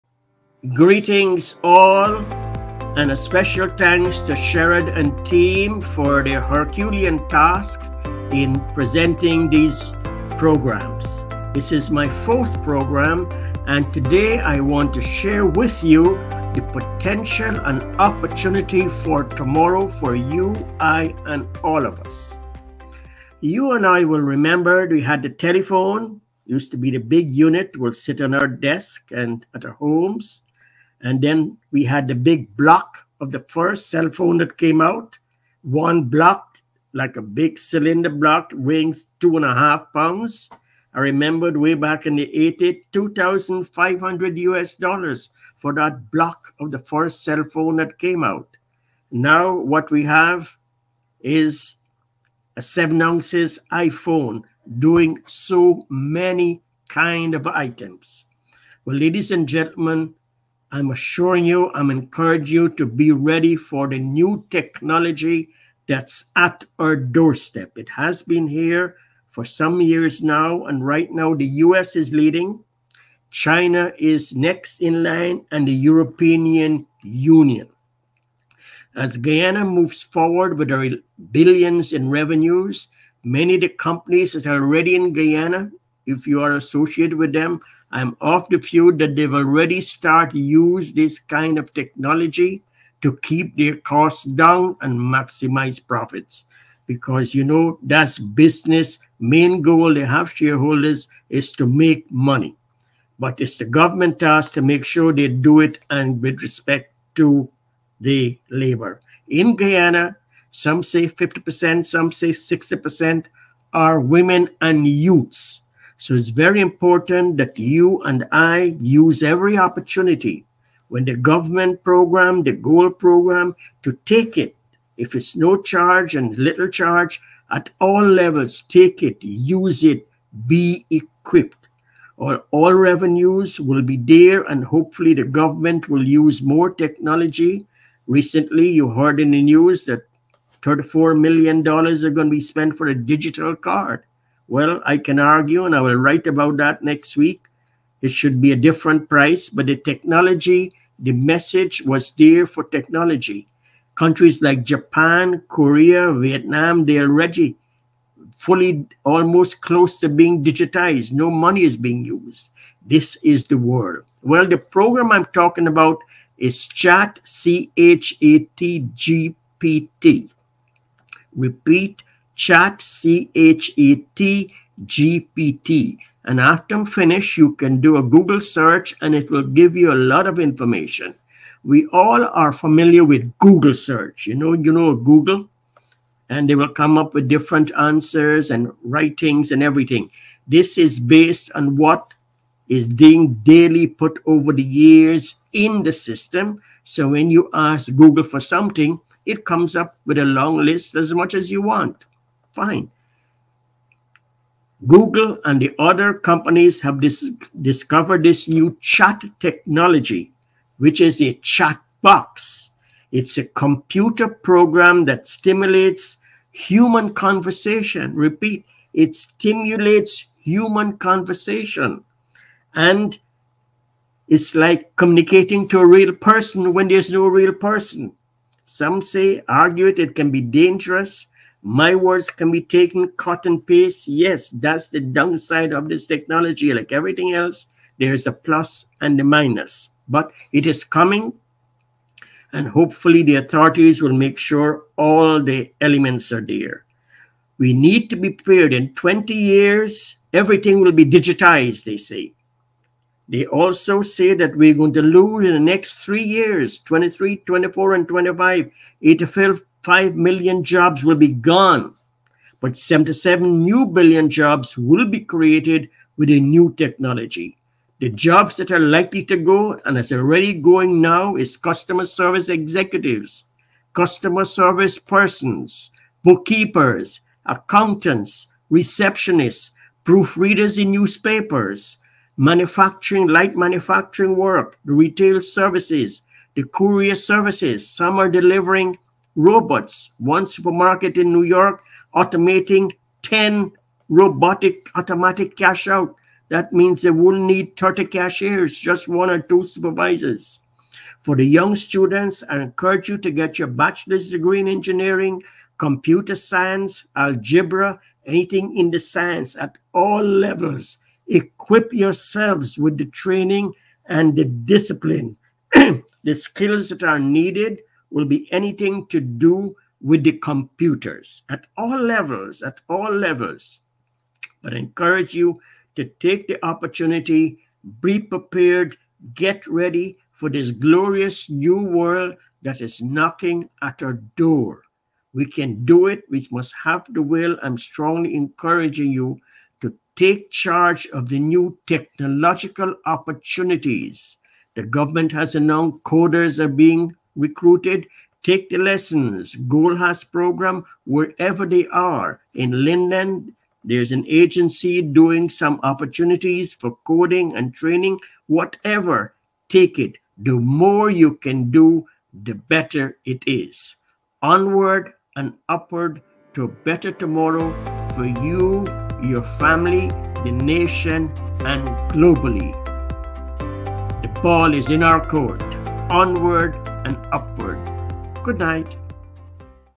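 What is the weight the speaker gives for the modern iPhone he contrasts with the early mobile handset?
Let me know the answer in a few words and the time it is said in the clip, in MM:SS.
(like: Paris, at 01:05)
7 ounces, at 00:52.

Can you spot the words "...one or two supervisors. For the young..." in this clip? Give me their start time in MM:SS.
04:59.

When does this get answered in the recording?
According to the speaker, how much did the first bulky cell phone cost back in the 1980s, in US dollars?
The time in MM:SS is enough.
00:42.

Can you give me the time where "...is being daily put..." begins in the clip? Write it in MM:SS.
03:12.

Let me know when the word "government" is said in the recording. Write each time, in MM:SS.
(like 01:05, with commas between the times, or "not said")
01:43, 02:01, 02:15, 05:44.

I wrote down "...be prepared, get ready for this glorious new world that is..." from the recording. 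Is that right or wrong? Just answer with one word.
right.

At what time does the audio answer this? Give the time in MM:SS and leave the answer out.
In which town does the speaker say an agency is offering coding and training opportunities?
05:52.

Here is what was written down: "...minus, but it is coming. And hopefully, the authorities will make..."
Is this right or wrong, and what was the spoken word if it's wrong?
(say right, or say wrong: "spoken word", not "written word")
right.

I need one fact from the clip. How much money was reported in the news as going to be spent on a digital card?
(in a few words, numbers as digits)
$34 million.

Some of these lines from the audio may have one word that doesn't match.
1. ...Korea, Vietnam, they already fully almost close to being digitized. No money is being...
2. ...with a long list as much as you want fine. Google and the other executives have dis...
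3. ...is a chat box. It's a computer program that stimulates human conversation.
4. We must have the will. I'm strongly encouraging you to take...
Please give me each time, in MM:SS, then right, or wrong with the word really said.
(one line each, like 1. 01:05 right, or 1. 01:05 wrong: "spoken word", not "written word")
1. 02:35 right
2. 03:20 wrong: "companies", not "executives"
3. 03:31 right
4. 05:36 right.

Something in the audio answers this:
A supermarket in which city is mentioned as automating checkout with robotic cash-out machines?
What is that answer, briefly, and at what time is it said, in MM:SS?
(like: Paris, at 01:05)
New York, at 04:51.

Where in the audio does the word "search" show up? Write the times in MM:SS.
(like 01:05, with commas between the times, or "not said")
02:58, 03:03.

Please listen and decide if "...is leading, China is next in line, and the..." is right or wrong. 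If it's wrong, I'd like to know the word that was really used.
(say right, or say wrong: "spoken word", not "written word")
right.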